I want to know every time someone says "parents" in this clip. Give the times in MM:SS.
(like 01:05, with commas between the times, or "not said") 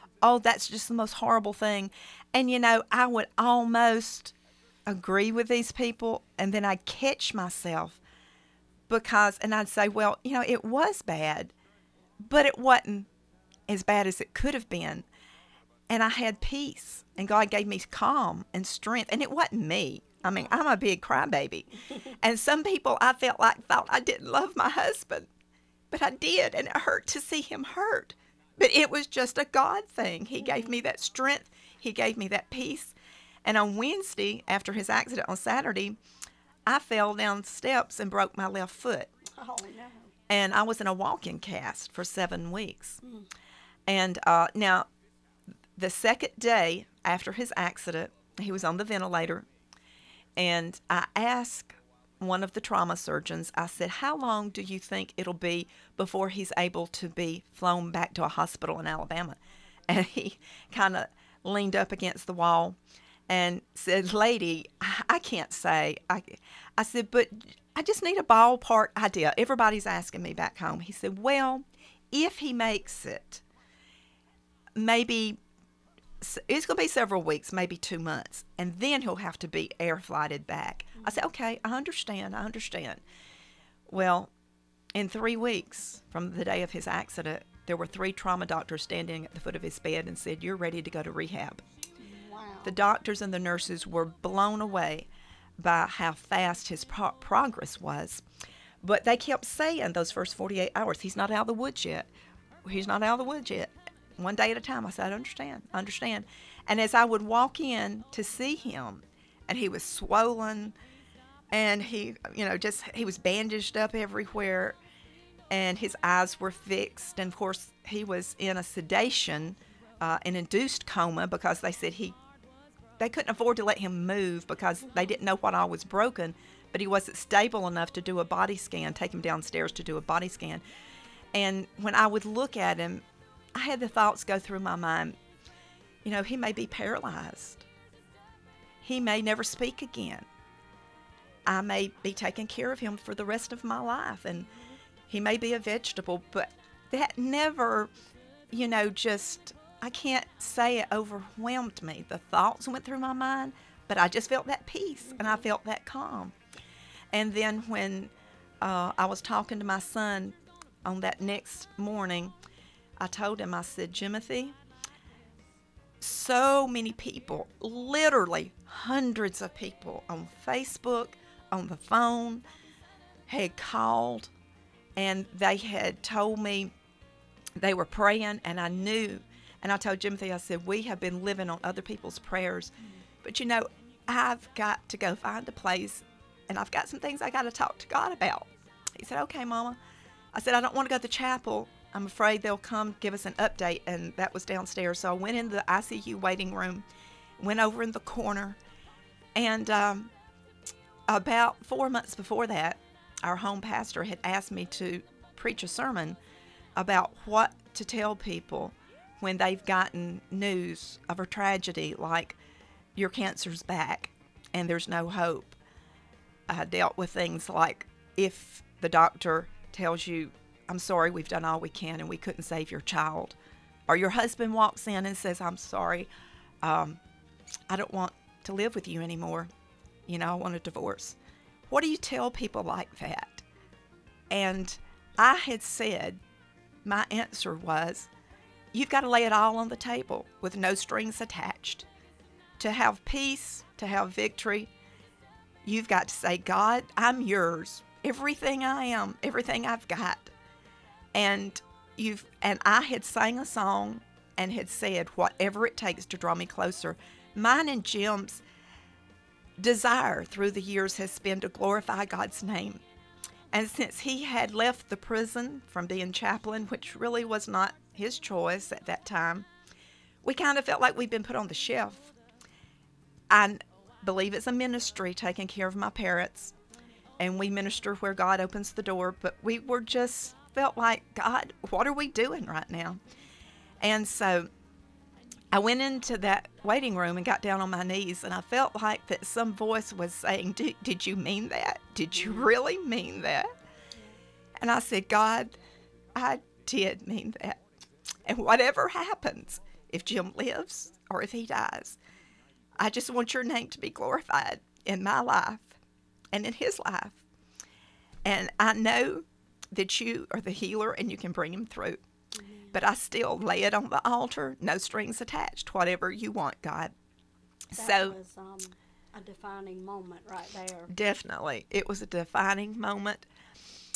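04:35.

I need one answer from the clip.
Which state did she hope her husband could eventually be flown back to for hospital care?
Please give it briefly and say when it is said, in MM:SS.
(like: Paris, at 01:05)
Alabama, at 00:58.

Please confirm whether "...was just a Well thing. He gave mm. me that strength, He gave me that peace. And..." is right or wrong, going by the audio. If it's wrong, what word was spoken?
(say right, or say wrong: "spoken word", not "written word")
wrong: "God", not "Well".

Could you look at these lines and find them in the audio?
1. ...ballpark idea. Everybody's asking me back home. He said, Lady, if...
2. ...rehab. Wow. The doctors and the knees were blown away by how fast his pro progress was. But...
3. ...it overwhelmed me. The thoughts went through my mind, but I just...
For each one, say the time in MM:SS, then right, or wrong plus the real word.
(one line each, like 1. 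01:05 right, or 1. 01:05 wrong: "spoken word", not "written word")
1. 01:08 wrong: "Well", not "Lady"
2. 01:31 wrong: "nurses", not "knees"
3. 02:30 right.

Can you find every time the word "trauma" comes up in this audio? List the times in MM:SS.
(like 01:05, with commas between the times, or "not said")
00:52, 01:28.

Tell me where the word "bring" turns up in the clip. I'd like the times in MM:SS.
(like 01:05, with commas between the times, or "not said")
05:11.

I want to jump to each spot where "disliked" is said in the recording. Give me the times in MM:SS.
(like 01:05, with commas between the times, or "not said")
not said.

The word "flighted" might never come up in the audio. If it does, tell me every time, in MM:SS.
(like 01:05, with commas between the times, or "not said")
01:19.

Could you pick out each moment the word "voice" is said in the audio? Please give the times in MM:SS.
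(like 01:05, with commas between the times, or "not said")
04:49.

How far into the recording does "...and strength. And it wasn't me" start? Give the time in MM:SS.
00:18.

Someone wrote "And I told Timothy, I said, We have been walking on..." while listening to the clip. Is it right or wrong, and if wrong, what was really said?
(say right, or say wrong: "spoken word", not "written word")
wrong: "living", not "walking".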